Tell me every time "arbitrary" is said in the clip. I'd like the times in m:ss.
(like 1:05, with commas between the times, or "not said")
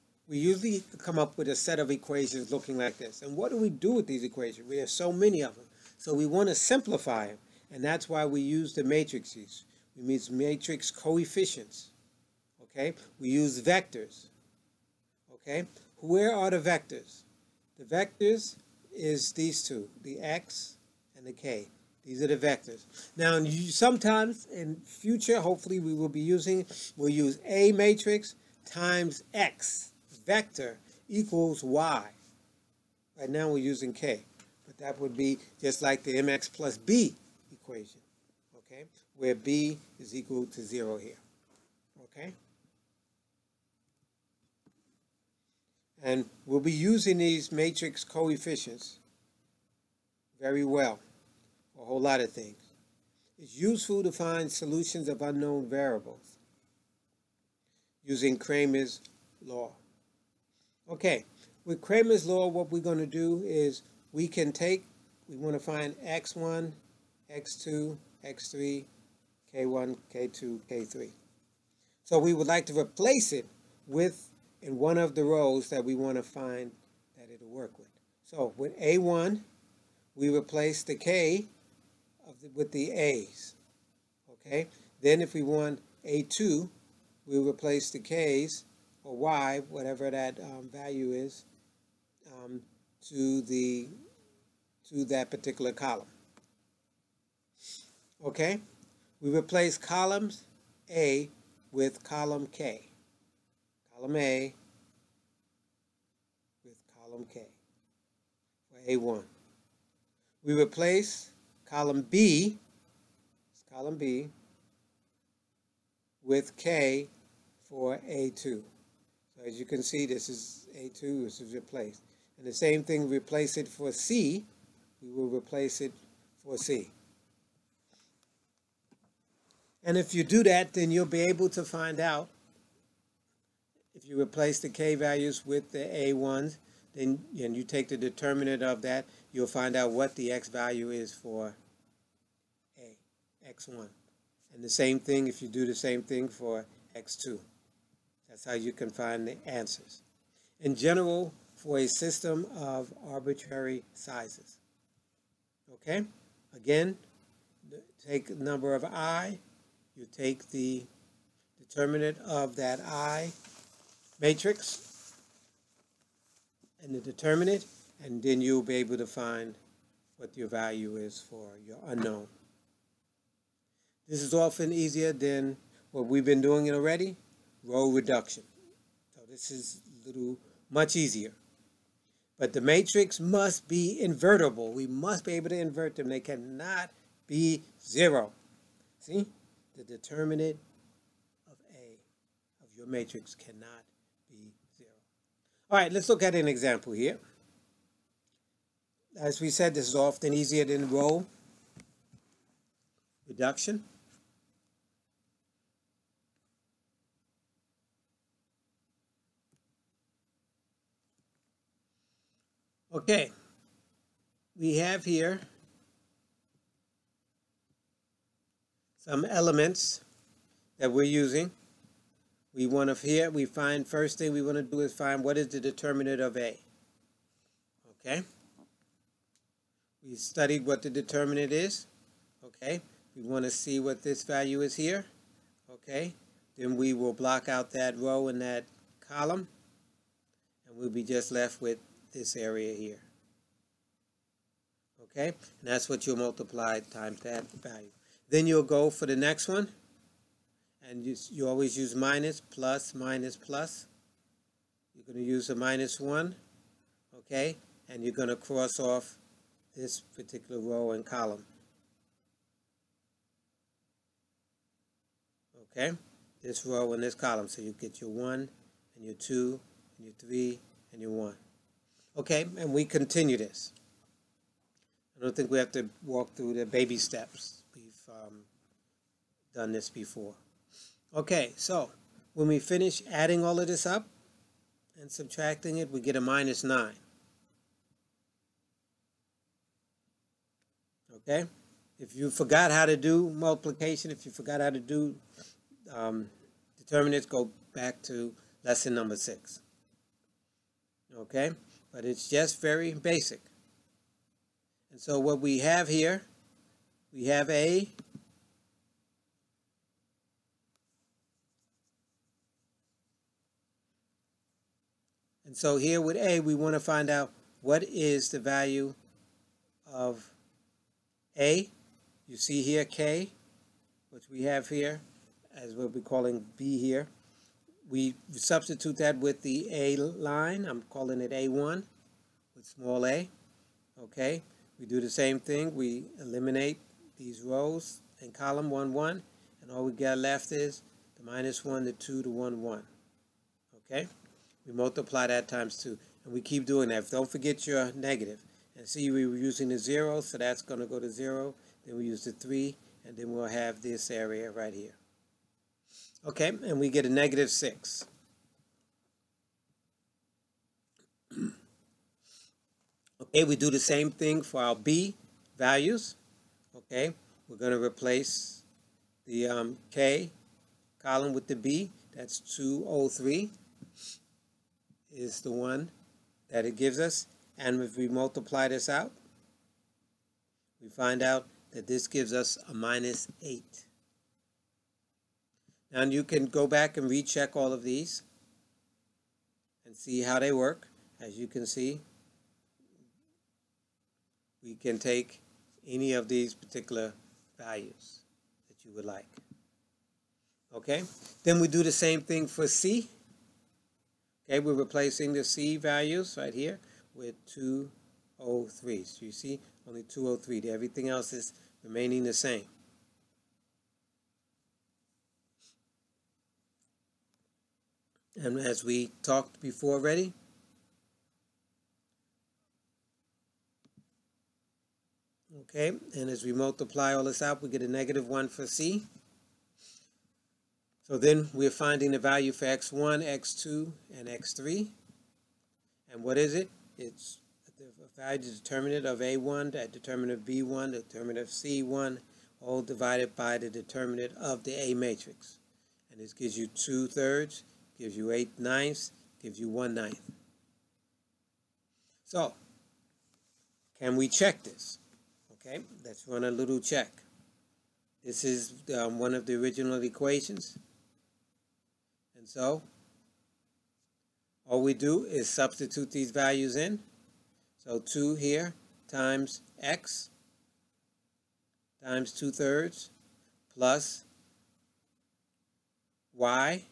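2:33.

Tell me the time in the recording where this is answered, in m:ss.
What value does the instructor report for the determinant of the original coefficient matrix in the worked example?
4:46.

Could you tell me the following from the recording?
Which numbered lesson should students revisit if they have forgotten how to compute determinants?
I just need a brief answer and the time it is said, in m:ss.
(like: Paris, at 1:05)
6, at 4:58.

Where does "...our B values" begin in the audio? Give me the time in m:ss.
6:04.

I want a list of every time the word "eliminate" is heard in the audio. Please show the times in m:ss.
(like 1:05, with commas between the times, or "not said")
5:36.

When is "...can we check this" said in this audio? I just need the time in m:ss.
7:34.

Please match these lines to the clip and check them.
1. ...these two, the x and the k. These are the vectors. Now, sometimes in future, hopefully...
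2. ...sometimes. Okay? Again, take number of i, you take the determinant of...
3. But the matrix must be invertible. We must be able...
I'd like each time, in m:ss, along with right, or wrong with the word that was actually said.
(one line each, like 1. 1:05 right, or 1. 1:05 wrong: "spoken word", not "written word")
1. 0:19 right
2. 2:33 wrong: "sizes", not "sometimes"
3. 3:02 right.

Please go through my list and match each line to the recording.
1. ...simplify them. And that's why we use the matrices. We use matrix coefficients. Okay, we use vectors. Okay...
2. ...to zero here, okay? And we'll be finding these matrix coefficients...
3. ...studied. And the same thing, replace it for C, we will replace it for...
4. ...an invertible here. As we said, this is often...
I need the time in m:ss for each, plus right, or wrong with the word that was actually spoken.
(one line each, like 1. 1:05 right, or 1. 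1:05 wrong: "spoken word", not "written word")
1. 0:06 right
2. 0:40 wrong: "using", not "finding"
3. 2:01 wrong: "replaced", not "studied"
4. 3:16 wrong: "example", not "invertible".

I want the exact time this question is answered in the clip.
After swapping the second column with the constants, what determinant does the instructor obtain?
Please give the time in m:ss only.
6:22.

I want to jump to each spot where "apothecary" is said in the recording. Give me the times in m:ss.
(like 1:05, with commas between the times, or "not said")
not said.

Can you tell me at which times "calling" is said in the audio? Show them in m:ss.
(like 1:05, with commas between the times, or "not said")
5:26, 5:30.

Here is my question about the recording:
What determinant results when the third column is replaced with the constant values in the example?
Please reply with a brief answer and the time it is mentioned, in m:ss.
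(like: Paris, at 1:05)
-1, at 7:07.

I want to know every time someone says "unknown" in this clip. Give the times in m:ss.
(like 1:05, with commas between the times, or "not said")
0:55, 2:51.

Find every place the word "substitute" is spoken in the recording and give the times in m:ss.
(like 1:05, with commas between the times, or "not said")
5:28, 7:45.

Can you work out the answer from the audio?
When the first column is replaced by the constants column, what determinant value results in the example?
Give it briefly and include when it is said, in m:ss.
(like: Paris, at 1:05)
-6, at 5:57.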